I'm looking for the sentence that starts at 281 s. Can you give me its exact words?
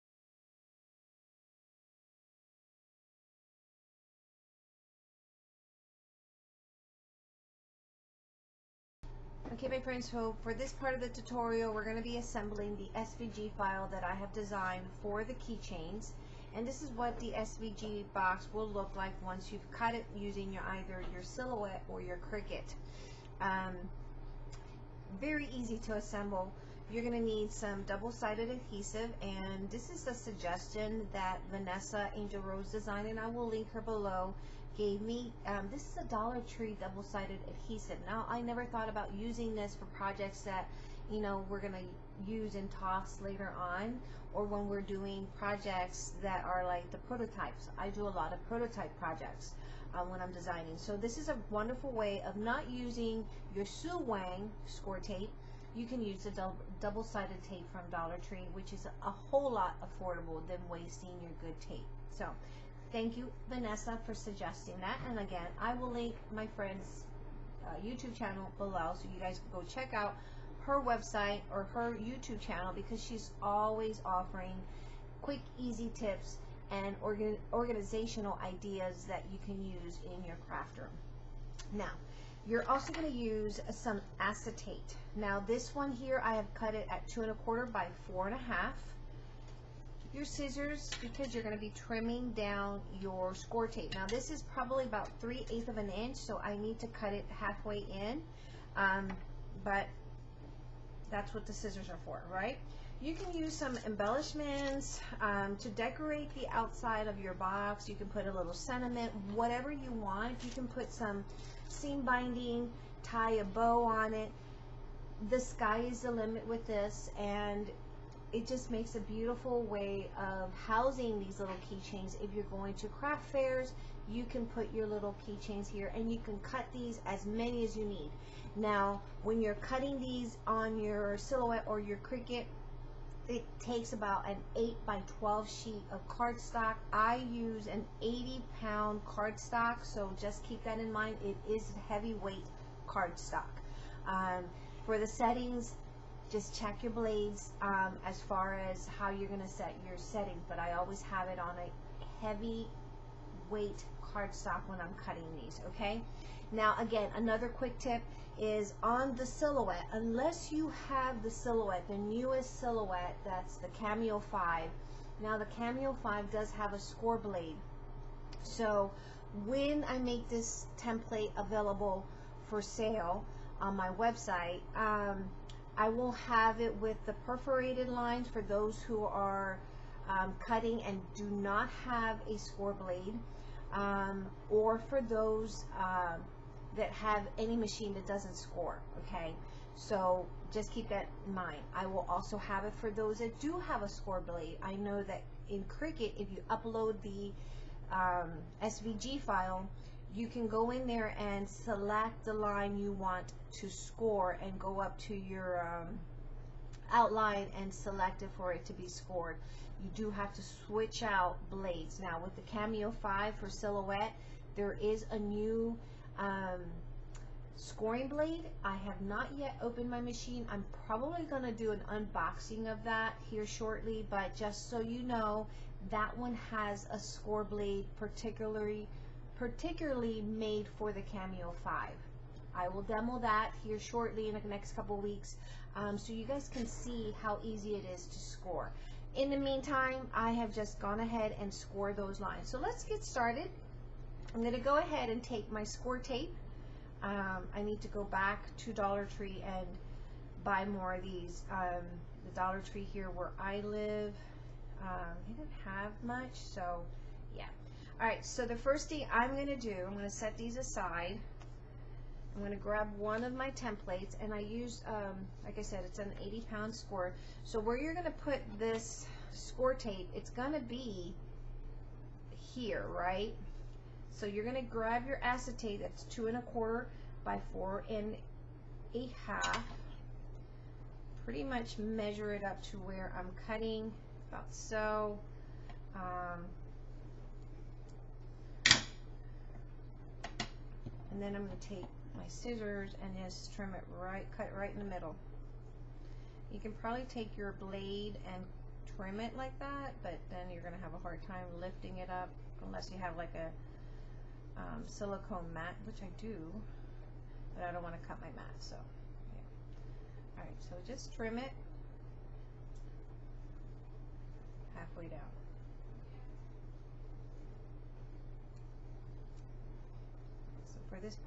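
Pretty much measure it up to where I'm cutting, about so.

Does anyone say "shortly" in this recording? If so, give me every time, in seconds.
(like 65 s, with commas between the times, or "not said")
223 s, 233 s.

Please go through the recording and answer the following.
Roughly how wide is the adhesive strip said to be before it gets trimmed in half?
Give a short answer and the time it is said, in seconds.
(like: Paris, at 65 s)
3/8 inch, at 95 s.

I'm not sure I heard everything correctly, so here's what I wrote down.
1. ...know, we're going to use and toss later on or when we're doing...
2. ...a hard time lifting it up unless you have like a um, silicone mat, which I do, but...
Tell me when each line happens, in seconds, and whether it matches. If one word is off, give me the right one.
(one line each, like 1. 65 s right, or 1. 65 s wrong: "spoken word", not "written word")
1. 41 s right
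2. 300 s right.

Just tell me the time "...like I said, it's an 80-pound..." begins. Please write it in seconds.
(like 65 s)
265 s.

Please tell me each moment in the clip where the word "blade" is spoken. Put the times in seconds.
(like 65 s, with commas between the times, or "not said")
146 s, 167 s, 182 s, 194 s, 211 s, 218 s, 227 s, 297 s.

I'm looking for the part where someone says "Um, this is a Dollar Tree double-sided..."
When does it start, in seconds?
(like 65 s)
35 s.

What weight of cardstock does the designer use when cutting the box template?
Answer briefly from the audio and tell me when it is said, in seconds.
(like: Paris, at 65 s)
80 pound, at 138 s.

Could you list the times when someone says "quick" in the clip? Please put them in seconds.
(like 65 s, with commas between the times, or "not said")
75 s, 157 s.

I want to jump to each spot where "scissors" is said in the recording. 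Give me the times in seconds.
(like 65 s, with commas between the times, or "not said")
90 s, 101 s, 292 s.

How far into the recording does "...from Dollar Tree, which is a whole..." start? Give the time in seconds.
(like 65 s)
57 s.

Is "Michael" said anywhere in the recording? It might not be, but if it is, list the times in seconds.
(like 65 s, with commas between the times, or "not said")
not said.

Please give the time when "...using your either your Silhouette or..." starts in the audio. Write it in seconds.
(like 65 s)
20 s.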